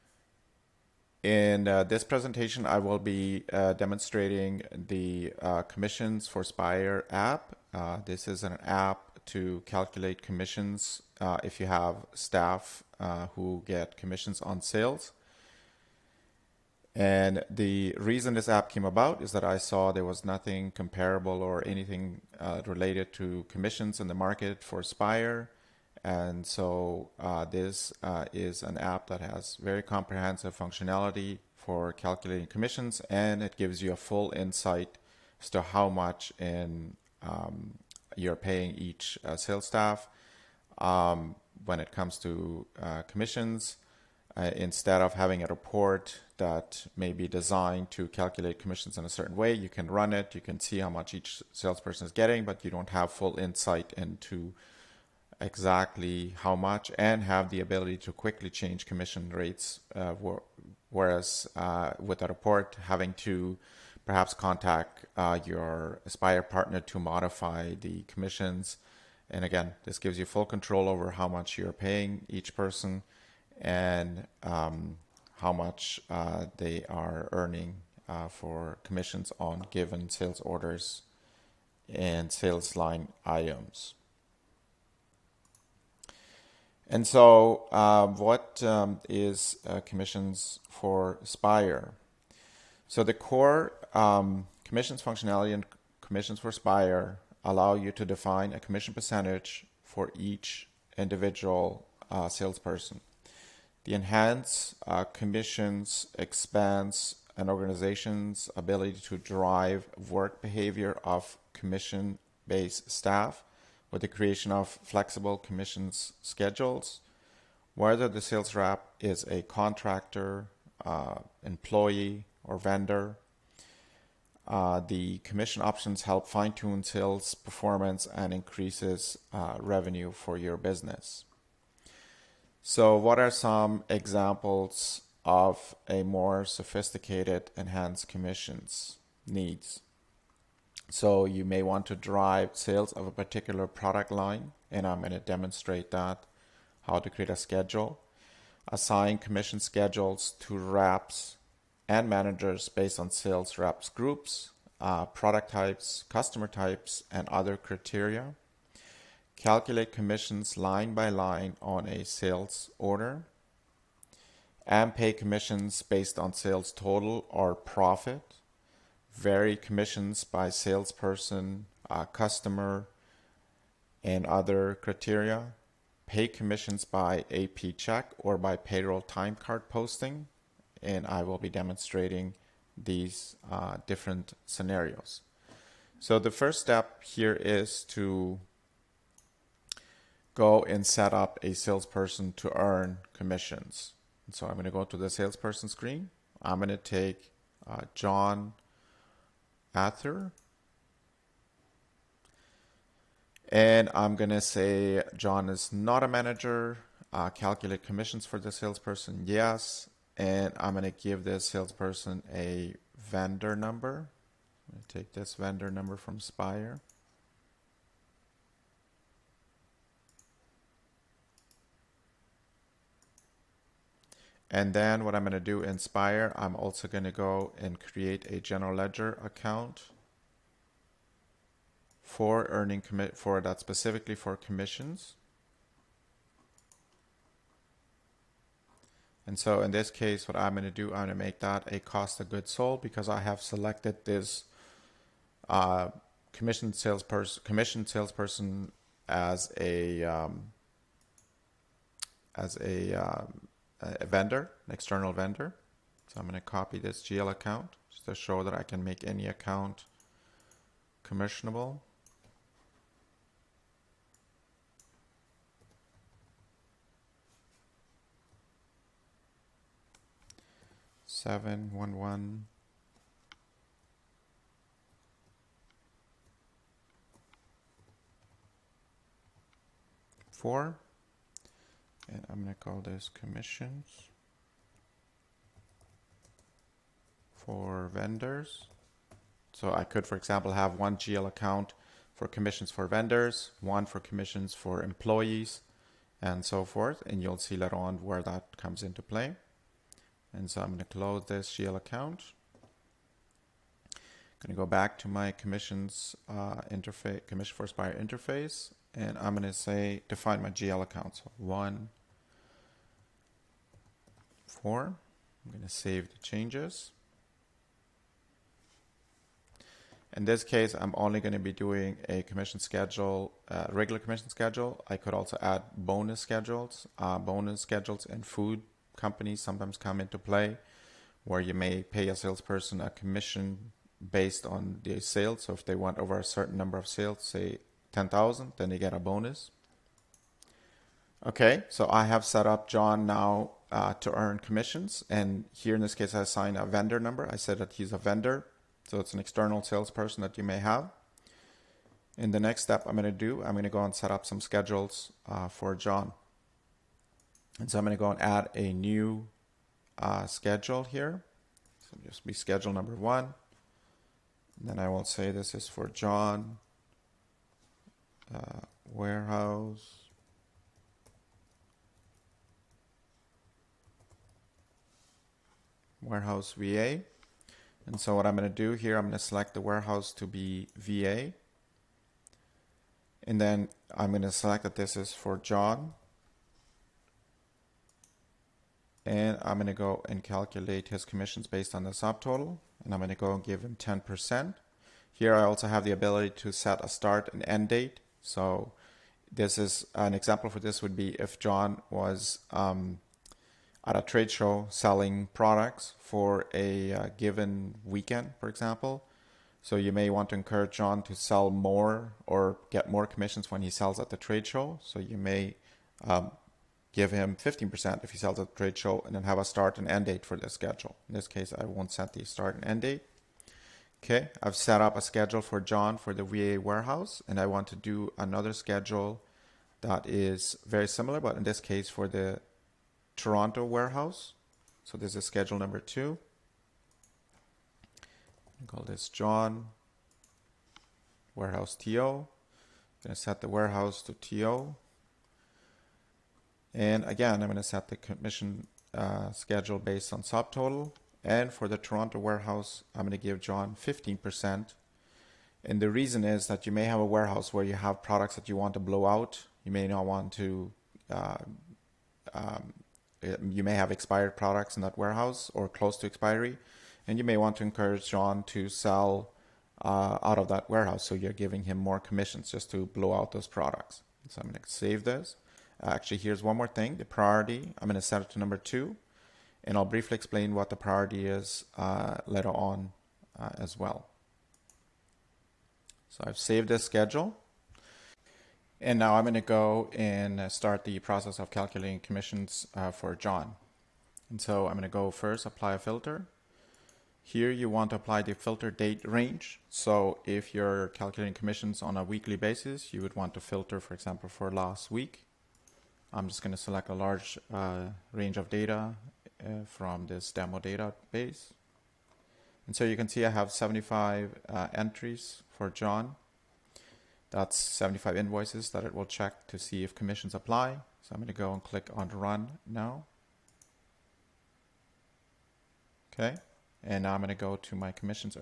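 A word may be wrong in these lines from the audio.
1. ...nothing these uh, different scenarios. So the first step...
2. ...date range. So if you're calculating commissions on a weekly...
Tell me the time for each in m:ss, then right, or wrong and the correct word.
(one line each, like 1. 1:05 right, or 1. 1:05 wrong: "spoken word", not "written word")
1. 3:01 wrong: "demonstrating", not "nothing"
2. 8:18 right.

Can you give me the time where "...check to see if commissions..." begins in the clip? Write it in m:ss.
8:39.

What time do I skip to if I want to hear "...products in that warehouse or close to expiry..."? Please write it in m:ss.
7:44.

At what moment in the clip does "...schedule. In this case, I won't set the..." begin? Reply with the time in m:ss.
7:00.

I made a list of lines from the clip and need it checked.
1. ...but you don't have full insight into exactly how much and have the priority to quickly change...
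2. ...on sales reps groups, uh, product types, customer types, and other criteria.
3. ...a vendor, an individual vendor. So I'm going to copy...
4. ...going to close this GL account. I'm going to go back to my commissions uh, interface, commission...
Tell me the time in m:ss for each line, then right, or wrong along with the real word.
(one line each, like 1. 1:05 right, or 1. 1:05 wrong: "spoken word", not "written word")
1. 0:52 wrong: "ability", not "priority"
2. 2:32 right
3. 4:13 wrong: "external", not "individual"
4. 5:00 right.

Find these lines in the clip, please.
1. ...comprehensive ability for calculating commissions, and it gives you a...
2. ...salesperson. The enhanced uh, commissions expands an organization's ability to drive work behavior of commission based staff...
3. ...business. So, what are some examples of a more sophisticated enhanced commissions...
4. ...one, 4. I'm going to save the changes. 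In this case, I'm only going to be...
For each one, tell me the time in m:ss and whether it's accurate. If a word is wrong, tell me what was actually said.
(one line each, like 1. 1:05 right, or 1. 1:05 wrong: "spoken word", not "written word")
1. 0:29 wrong: "functionality", not "ability"
2. 1:42 right
3. 2:10 right
4. 5:11 right.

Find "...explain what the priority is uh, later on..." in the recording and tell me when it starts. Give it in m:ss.
8:00.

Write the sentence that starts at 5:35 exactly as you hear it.
So if they want over a certain number of sales, say 10,000, then they get a bonus.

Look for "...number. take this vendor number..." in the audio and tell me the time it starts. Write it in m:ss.
3:33.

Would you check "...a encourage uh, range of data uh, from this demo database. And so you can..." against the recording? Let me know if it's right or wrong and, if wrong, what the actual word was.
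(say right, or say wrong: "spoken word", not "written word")
wrong: "large", not "encourage".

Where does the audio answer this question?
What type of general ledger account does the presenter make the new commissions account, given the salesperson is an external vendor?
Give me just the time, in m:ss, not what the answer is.
4:01.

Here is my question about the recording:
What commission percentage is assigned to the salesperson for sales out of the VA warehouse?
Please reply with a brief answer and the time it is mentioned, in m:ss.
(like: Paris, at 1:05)
10%, at 6:33.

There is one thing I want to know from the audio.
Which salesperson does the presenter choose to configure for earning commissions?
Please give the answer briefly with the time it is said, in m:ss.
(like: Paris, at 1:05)
John Ather, at 3:17.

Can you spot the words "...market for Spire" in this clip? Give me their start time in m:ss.
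0:24.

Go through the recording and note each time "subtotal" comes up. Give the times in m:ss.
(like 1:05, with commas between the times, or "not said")
6:31, 7:30.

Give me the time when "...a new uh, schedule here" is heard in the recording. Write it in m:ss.
5:58.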